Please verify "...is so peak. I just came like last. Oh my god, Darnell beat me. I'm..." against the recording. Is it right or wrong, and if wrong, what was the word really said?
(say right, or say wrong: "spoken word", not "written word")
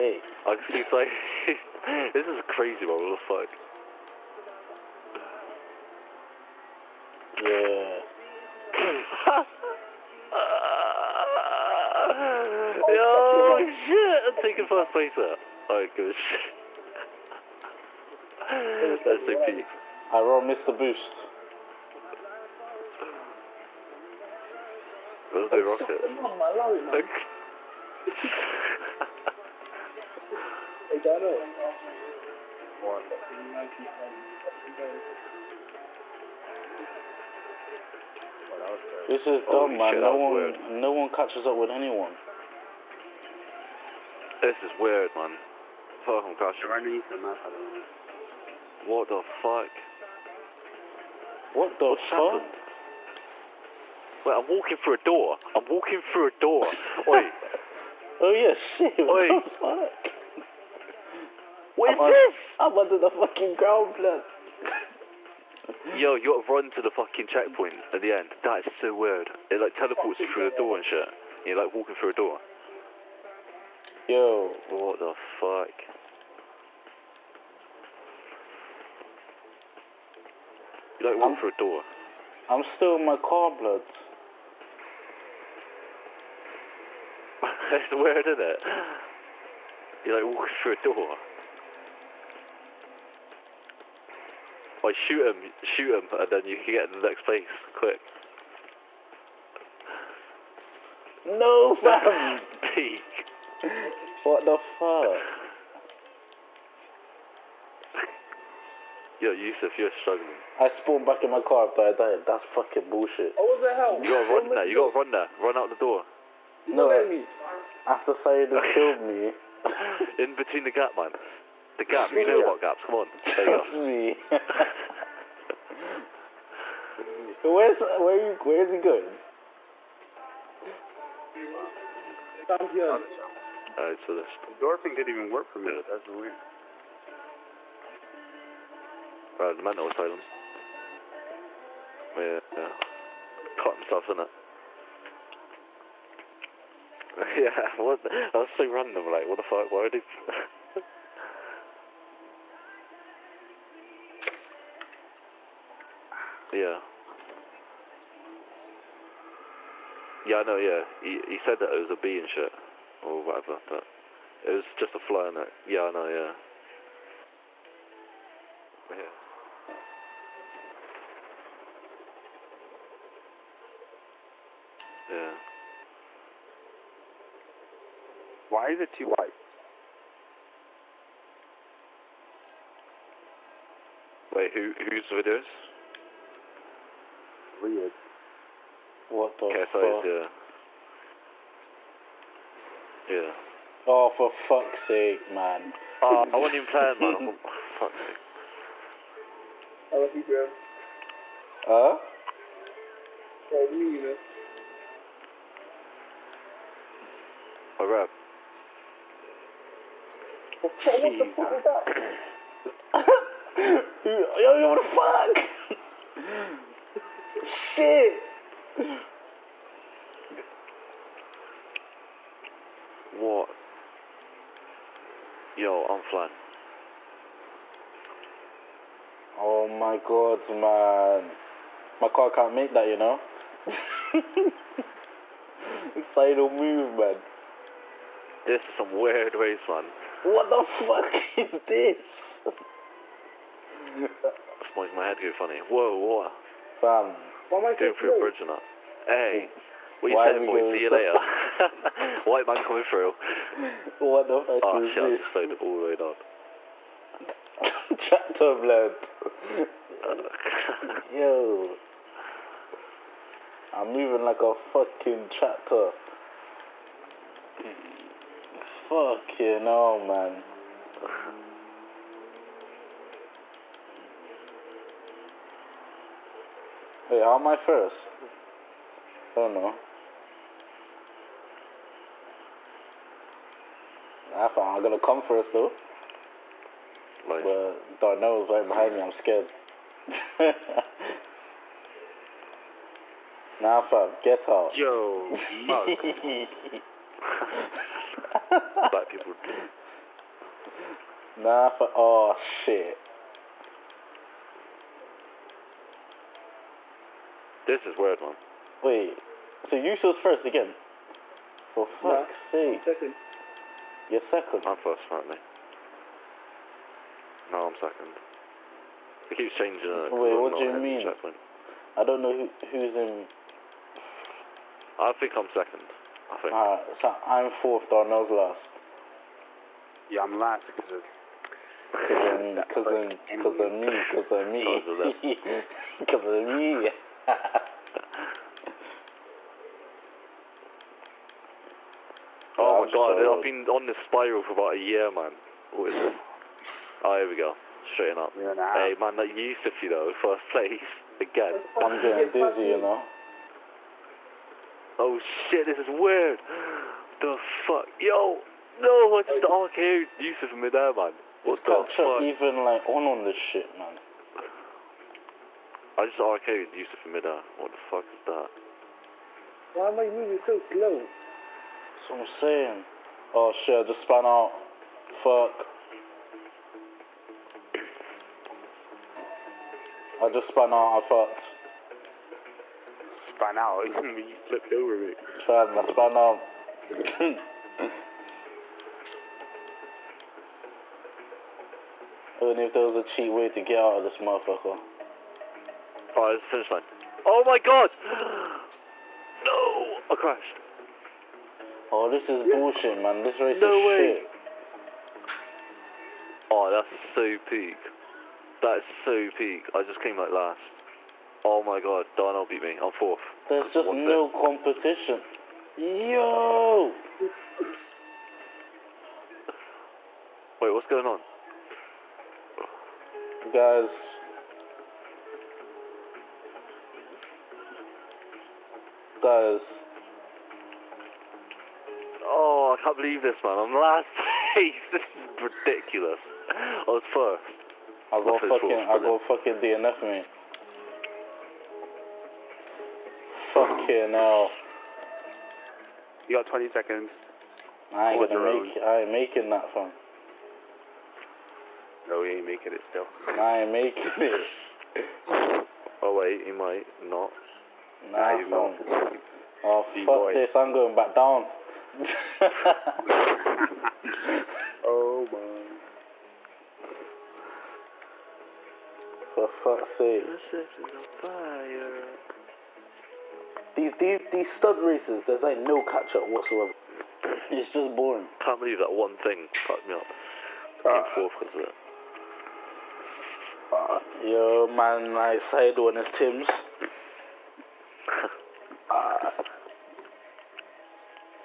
right.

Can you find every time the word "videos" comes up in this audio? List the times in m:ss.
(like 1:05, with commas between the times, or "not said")
3:05.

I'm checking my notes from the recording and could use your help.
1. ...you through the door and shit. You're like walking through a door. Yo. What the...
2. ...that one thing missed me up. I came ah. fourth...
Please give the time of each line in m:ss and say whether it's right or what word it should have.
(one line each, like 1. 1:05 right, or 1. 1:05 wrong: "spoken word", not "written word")
1. 1:10 right
2. 7:58 wrong: "fucked", not "missed".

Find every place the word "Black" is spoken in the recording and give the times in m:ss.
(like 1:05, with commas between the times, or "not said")
4:58.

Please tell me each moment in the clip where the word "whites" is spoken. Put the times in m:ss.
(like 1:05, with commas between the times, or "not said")
2:59, 4:12.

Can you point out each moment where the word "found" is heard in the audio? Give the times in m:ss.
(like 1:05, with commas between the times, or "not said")
4:44.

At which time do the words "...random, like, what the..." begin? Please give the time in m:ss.
2:28.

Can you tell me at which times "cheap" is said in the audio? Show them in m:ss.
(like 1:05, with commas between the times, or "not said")
6:33.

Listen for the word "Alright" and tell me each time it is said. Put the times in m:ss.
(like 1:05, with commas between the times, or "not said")
0:15, 2:13, 5:26.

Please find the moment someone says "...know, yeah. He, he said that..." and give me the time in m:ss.
2:40.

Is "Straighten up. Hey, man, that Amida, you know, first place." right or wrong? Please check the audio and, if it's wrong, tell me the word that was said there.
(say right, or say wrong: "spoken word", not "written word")
wrong: "Yusuf", not "Amida".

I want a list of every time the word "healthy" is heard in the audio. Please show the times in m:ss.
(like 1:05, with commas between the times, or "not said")
not said.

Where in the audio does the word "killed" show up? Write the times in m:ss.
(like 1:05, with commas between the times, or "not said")
1:58.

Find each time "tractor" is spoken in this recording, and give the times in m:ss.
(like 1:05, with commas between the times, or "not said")
4:17, 4:25.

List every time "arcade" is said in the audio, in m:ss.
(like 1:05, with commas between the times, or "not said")
5:59, 6:06.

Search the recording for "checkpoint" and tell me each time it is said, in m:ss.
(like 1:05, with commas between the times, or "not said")
1:07, 5:21.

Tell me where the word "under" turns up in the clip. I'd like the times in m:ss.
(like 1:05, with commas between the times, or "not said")
1:02.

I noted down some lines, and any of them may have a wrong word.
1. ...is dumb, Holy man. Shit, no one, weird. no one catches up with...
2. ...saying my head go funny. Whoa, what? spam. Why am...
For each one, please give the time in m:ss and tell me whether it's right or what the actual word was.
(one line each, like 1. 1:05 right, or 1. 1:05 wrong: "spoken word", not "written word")
1. 0:39 right
2. 4:04 wrong: "making", not "saying".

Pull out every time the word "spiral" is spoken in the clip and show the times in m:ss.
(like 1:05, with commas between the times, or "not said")
5:44.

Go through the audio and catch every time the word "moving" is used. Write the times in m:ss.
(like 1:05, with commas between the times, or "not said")
4:23, 6:10.